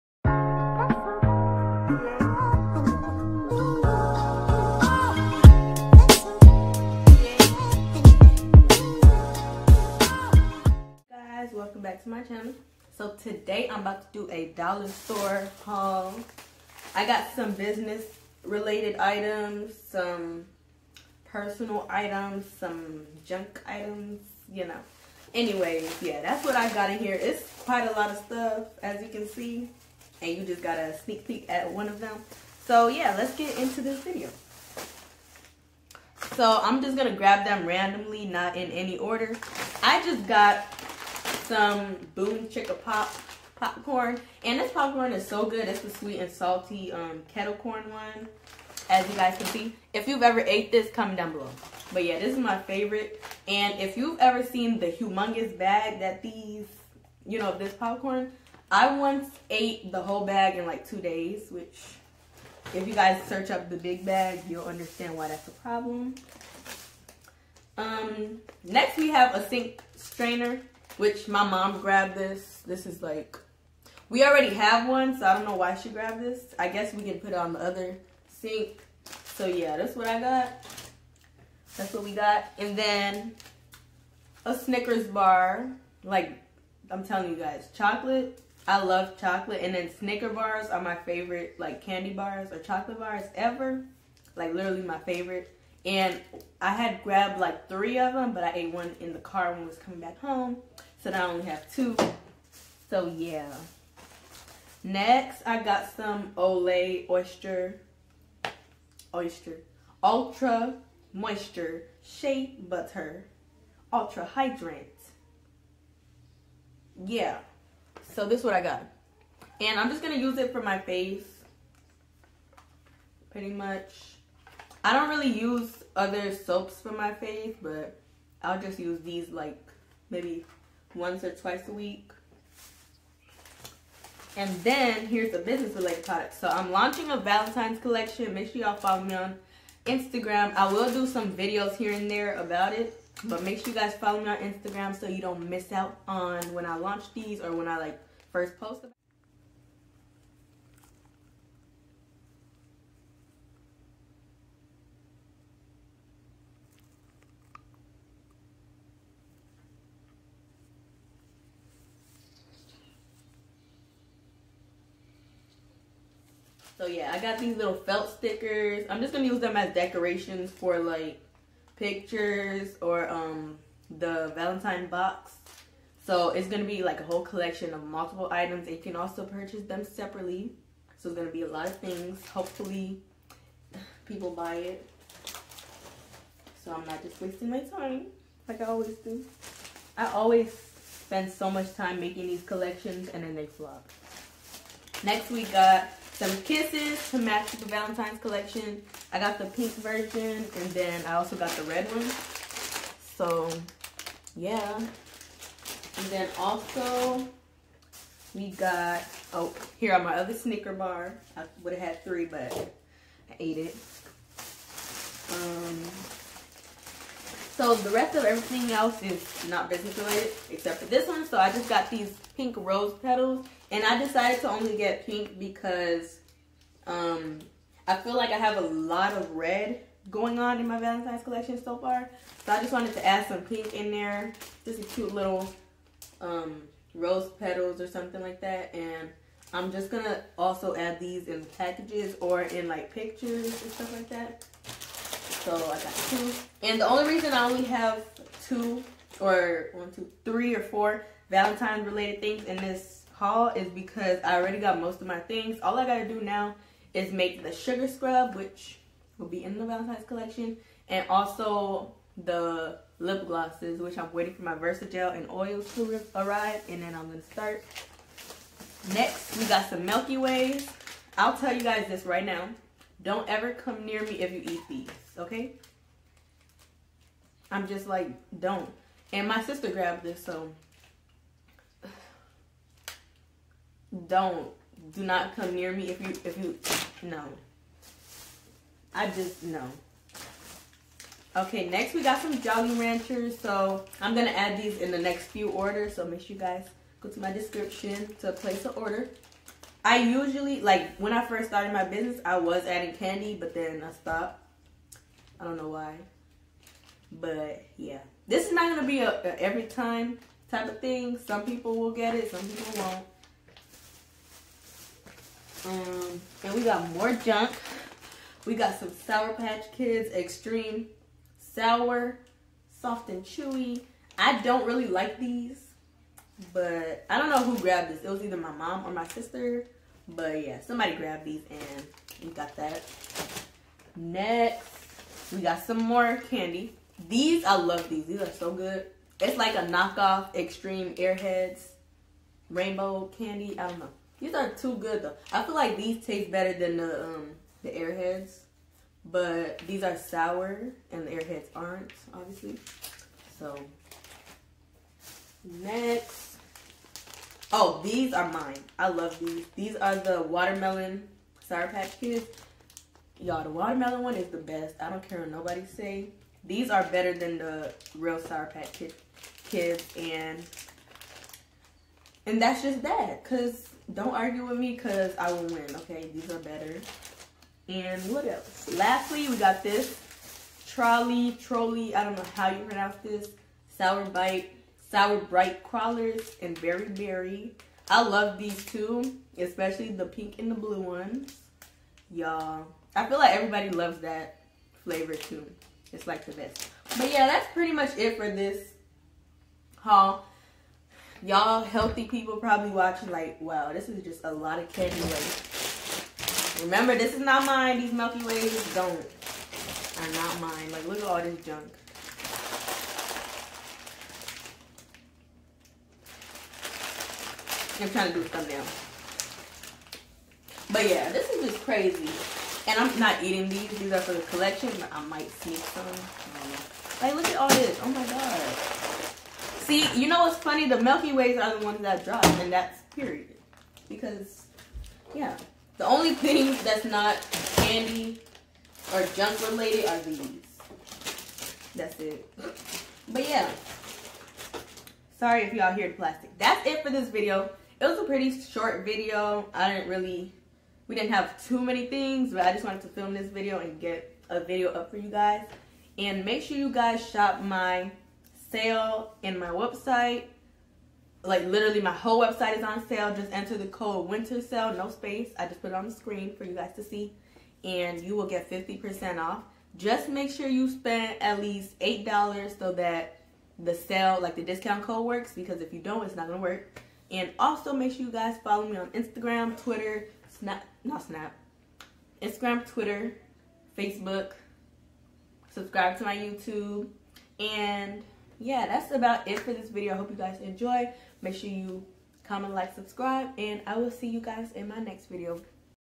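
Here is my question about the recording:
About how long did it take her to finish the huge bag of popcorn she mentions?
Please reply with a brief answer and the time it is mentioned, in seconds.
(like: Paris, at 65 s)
2 days, at 60 s.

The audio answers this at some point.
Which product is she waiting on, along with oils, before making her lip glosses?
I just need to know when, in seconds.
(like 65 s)
264 s.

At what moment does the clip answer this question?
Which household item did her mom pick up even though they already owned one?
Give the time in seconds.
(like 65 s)
69 s.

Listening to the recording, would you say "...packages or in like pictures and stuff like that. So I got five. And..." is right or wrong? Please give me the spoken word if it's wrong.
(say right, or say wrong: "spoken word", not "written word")
wrong: "two", not "five".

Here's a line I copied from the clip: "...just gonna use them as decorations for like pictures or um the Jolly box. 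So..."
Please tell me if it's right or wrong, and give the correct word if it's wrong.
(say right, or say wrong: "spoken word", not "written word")
wrong: "Valentine", not "Jolly".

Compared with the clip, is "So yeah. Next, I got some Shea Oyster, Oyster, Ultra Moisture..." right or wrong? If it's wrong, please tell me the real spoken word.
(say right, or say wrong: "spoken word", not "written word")
wrong: "Olay", not "Shea".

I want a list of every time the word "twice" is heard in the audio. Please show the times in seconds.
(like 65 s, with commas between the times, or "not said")
131 s.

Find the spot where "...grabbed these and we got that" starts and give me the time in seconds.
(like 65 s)
330 s.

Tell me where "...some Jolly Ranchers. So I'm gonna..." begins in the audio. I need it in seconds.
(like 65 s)
292 s.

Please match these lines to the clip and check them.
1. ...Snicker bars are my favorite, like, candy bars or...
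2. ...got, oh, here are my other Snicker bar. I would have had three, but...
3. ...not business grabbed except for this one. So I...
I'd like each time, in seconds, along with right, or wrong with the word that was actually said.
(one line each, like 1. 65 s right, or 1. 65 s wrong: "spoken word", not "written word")
1. 89 s right
2. 208 s right
3. 219 s wrong: "related", not "grabbed".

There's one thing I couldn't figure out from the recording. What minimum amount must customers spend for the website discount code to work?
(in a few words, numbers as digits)
$8.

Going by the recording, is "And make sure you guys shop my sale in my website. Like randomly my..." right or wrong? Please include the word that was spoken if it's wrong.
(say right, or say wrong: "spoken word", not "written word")
wrong: "literally", not "randomly".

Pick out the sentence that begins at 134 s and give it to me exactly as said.
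And then here's the business related product.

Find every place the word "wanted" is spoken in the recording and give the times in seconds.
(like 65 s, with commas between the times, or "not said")
232 s, 452 s.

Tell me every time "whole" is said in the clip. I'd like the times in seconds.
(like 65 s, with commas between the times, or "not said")
60 s, 177 s, 461 s.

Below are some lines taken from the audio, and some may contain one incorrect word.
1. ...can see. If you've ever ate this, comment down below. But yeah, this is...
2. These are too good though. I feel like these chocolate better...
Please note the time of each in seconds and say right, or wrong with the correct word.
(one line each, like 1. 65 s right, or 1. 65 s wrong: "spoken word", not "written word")
1. 49 s right
2. 344 s wrong: "taste", not "chocolate".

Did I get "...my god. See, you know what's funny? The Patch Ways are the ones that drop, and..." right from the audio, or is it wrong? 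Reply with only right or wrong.
wrong.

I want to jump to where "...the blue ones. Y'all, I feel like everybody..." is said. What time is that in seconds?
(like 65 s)
390 s.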